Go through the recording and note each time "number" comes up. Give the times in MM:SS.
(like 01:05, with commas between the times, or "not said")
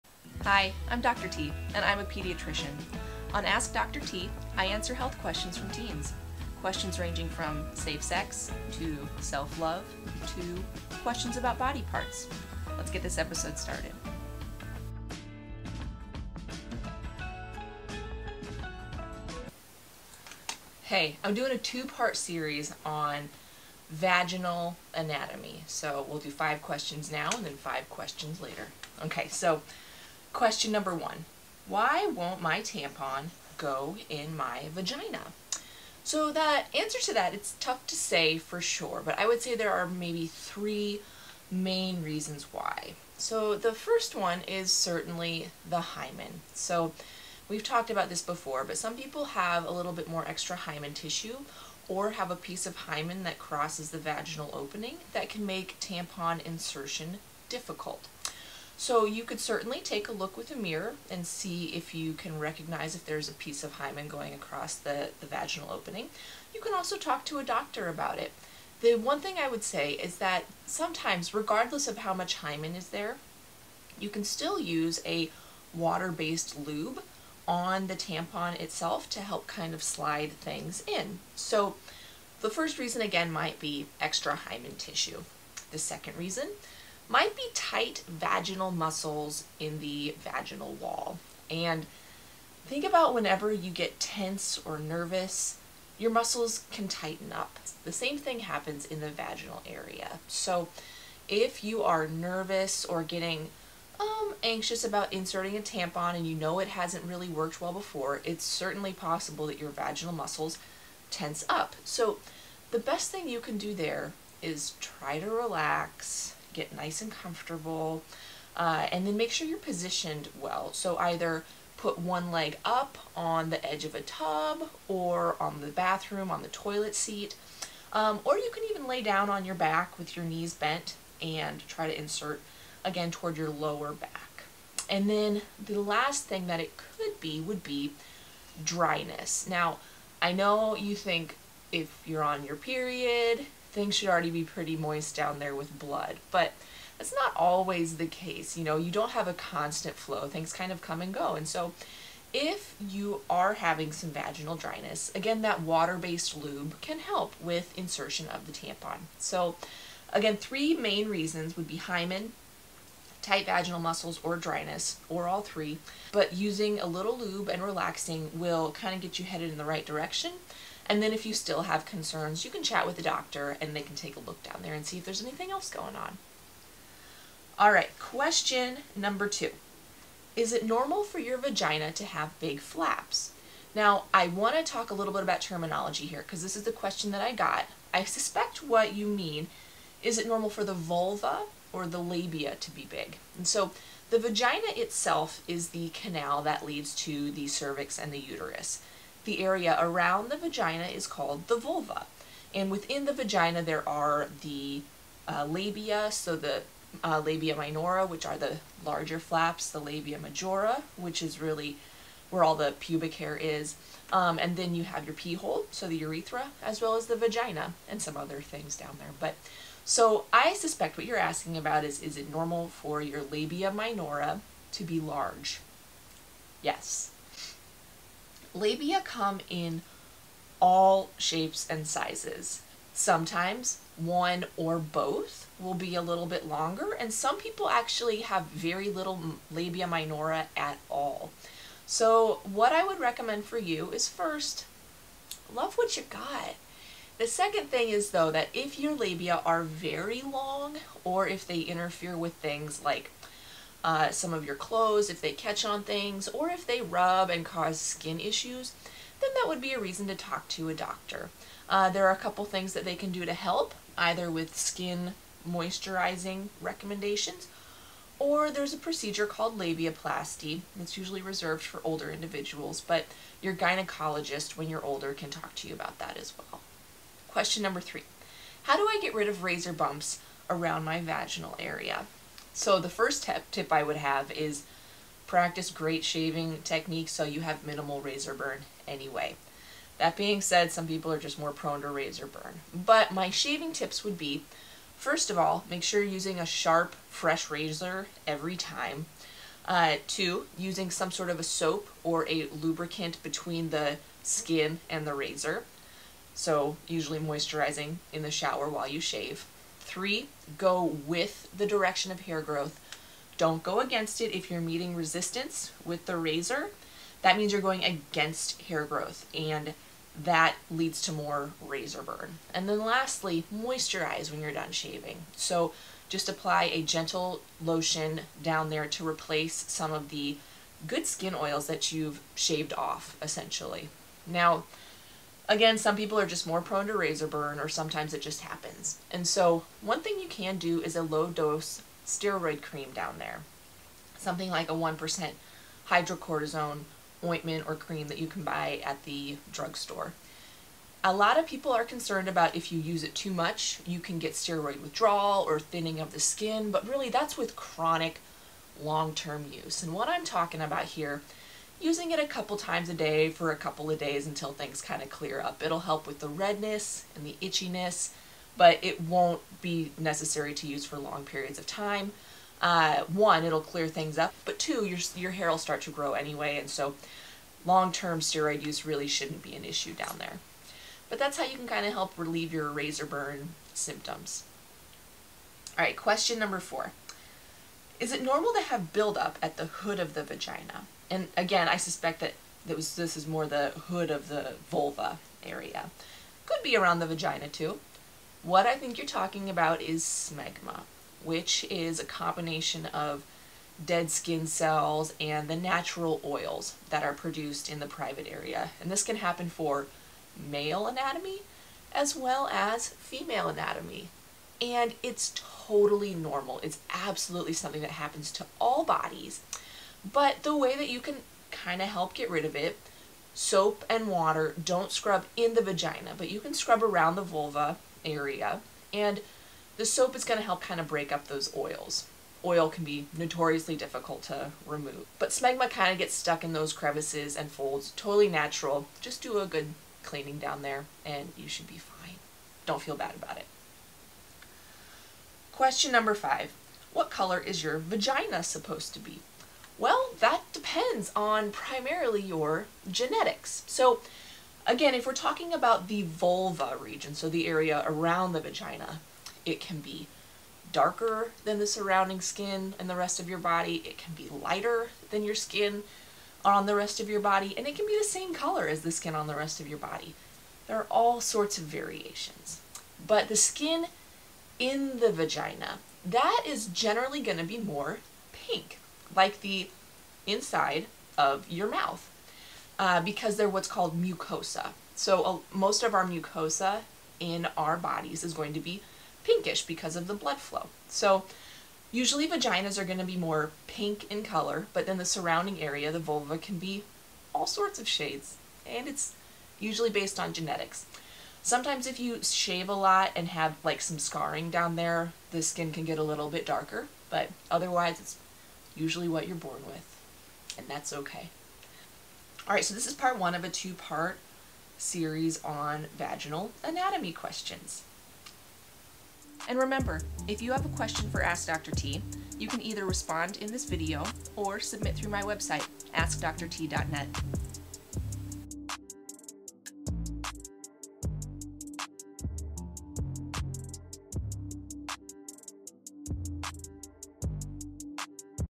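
00:30, 02:58, 04:37, 06:26, 07:25.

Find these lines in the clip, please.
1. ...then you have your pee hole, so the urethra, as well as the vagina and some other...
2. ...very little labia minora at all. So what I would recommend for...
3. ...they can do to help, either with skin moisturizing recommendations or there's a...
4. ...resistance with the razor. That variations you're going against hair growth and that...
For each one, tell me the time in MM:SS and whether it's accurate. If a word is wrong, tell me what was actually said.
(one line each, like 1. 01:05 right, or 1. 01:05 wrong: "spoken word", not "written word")
1. 03:34 right
2. 03:58 right
3. 04:22 right
4. 05:14 wrong: "means", not "variations".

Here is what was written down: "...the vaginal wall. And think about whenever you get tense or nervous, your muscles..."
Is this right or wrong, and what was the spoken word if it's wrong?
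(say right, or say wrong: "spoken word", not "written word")
right.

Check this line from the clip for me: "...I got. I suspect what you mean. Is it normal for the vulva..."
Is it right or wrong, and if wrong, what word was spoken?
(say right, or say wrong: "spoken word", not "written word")
right.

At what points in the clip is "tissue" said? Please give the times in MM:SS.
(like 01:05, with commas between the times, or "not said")
00:50, 01:24.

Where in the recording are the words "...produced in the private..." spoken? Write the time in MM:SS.
06:47.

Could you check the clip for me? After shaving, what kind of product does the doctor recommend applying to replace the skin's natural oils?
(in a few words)
gentle lotion.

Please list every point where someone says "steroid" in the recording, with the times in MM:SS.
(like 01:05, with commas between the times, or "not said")
05:42, 05:54, 06:18.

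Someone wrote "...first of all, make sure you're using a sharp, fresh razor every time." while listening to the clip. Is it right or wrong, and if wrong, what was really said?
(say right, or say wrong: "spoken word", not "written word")
right.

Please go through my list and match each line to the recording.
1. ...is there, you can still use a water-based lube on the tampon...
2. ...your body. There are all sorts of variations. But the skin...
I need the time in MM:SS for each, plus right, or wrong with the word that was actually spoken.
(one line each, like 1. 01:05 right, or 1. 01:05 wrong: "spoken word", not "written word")
1. 01:12 right
2. 07:49 right.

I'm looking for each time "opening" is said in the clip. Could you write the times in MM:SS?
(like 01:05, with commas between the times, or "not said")
00:54, 01:05.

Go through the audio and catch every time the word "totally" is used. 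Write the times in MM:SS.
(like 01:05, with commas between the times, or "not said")
06:55, 07:17.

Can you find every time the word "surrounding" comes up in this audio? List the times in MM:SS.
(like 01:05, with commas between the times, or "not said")
07:41, 08:15.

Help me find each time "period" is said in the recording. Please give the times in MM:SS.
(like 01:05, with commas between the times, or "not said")
02:22, 06:11.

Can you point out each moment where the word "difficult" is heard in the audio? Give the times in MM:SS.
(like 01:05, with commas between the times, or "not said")
00:57, 07:13.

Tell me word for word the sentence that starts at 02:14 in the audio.
And then the last thing that it could be would be dryness.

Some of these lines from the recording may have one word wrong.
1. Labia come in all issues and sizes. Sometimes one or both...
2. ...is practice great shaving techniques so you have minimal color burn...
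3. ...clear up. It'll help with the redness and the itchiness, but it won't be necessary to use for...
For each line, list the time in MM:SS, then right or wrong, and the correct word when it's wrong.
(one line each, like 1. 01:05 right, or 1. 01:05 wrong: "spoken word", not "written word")
1. 03:48 wrong: "shapes", not "issues"
2. 04:44 wrong: "razor", not "color"
3. 06:05 right.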